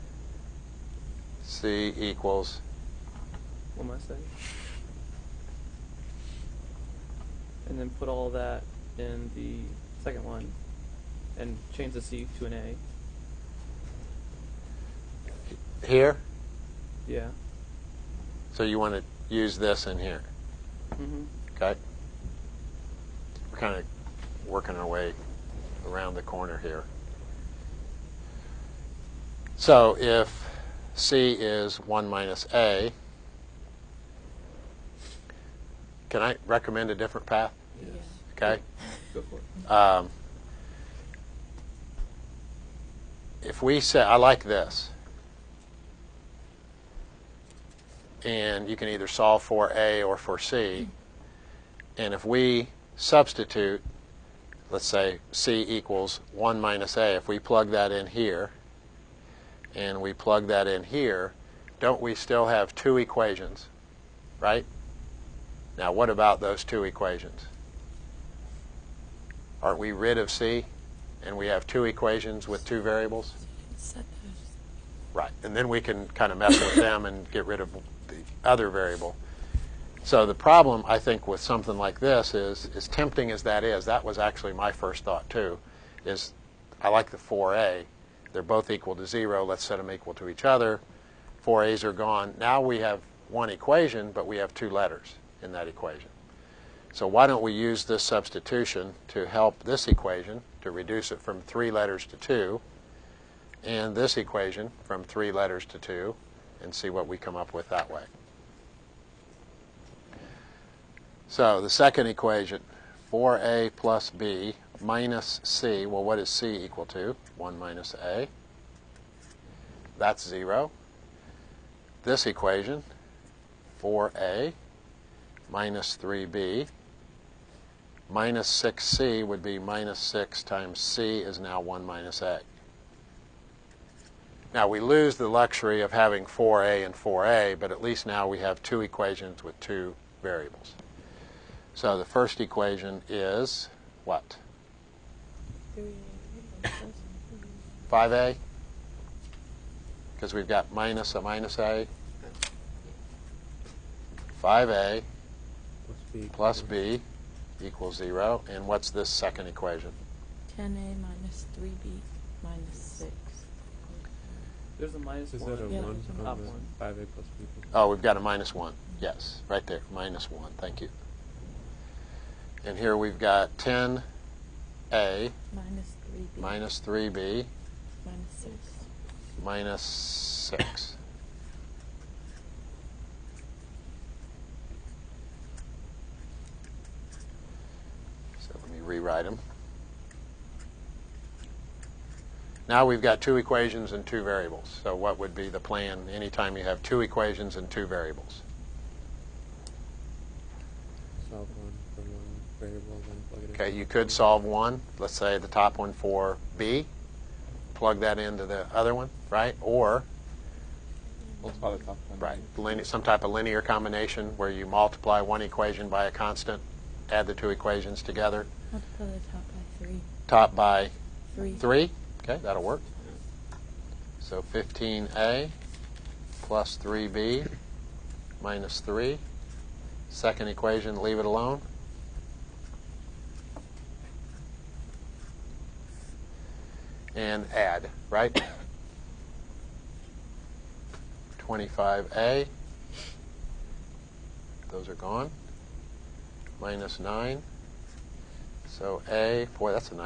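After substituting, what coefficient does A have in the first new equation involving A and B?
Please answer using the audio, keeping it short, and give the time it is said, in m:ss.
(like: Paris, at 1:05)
5a, at 2:34.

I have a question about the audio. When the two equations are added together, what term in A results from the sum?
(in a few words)
25a.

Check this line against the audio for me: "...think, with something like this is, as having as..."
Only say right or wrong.
wrong.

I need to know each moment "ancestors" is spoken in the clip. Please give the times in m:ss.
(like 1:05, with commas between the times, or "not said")
not said.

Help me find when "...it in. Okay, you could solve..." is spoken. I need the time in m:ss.
3:23.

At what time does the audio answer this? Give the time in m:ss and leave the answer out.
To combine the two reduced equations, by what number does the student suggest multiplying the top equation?
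3:40.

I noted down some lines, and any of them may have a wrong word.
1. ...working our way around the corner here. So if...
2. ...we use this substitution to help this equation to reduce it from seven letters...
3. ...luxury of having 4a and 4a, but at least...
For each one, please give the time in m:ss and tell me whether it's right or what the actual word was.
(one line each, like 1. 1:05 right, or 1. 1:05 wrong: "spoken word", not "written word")
1. 0:24 right
2. 1:37 wrong: "three", not "seven"
3. 2:15 right.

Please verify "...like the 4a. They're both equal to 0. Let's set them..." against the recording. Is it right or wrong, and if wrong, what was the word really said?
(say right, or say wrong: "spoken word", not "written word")
right.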